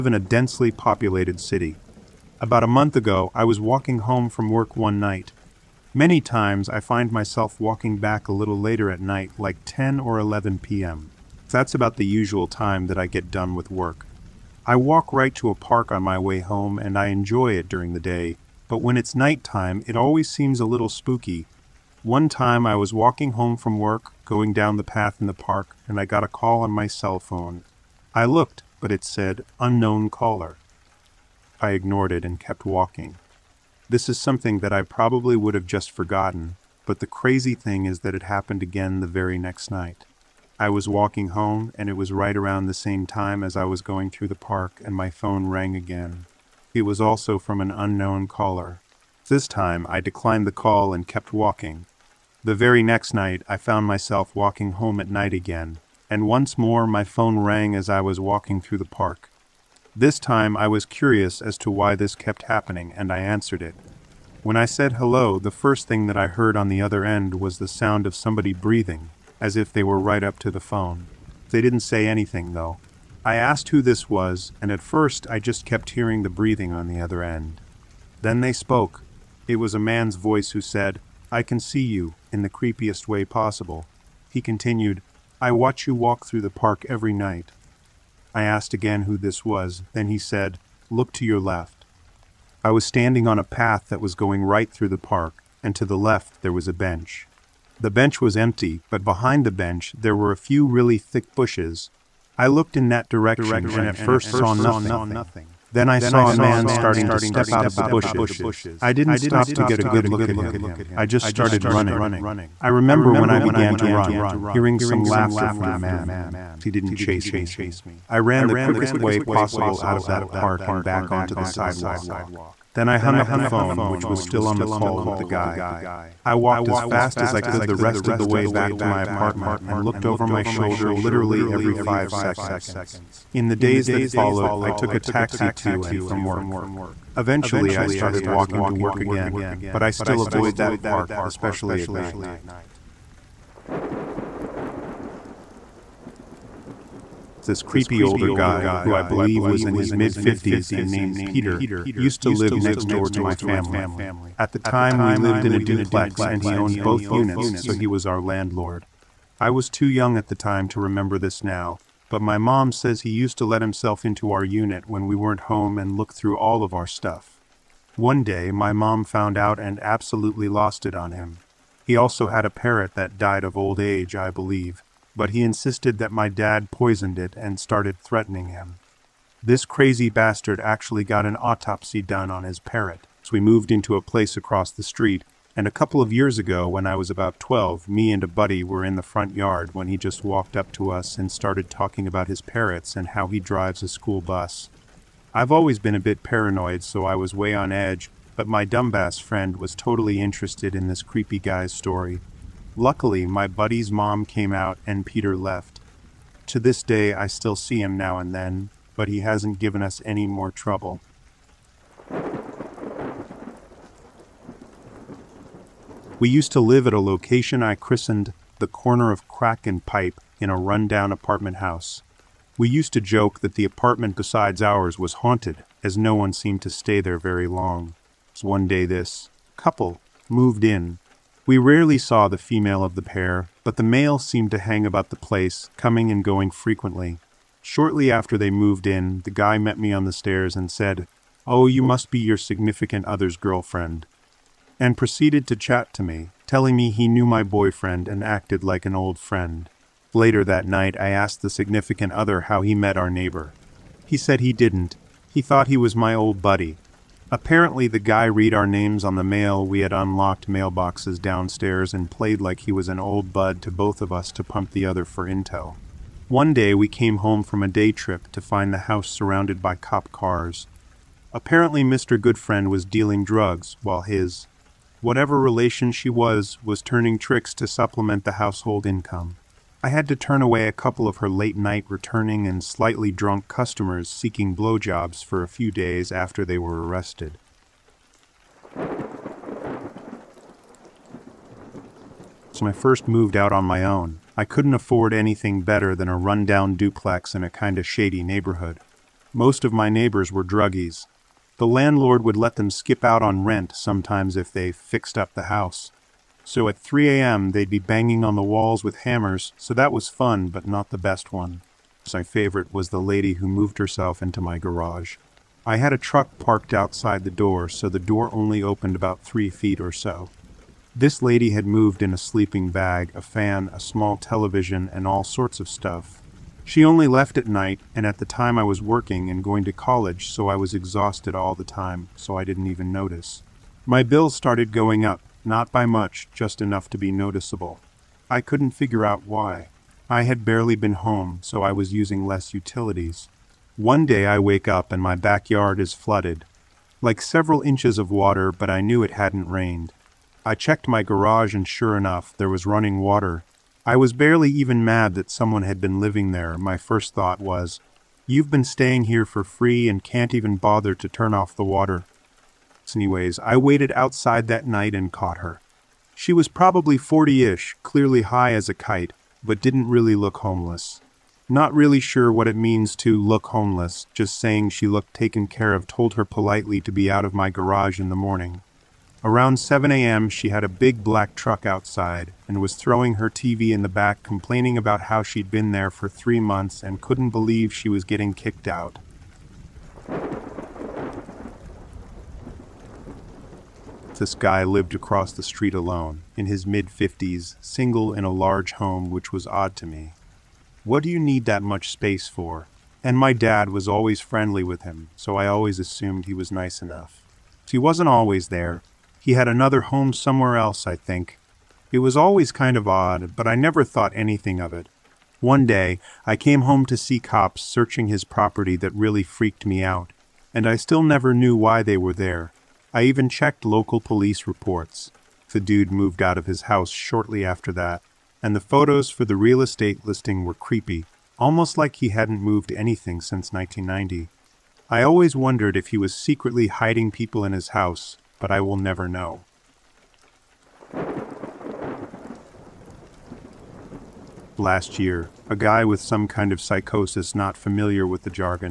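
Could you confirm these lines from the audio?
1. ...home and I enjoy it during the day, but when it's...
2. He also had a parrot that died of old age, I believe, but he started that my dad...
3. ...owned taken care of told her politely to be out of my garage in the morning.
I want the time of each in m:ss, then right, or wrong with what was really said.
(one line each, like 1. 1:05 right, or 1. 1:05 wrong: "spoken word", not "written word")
1. 0:16 right
2. 2:51 wrong: "insisted", not "started"
3. 6:14 wrong: "looked", not "owned".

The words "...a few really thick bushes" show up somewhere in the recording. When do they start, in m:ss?
1:40.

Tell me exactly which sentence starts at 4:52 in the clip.
So I first moved out on my own.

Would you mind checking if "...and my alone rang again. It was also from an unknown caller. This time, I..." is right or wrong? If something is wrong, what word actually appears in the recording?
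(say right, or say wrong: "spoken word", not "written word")
wrong: "phone", not "alone".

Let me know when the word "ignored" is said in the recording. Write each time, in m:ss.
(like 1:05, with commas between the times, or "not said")
0:31.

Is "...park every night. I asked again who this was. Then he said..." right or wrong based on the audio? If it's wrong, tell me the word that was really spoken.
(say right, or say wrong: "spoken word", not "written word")
right.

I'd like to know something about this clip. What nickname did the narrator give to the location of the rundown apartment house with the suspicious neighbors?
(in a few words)
Corner of Kraken Pipe.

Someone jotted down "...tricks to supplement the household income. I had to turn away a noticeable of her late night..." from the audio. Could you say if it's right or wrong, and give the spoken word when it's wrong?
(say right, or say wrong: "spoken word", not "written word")
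wrong: "couple", not "noticeable".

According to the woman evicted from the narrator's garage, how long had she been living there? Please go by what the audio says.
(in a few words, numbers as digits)
3 months.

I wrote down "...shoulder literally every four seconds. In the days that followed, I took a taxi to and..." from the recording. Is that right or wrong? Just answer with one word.
wrong.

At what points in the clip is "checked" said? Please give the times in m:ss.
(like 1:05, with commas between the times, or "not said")
5:50, 7:03.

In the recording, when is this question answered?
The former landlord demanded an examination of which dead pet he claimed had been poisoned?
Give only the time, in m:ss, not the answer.
3:02.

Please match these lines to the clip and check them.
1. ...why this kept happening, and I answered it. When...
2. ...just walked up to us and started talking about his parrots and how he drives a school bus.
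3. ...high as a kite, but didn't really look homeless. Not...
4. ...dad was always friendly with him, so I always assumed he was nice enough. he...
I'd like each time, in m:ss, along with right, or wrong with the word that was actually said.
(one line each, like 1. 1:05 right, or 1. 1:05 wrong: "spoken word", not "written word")
1. 1:01 right
2. 3:09 right
3. 6:08 right
4. 6:43 right.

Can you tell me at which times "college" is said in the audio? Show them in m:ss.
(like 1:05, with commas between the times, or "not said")
5:29.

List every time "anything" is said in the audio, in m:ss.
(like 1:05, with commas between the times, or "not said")
1:12, 4:55, 6:54, 7:12.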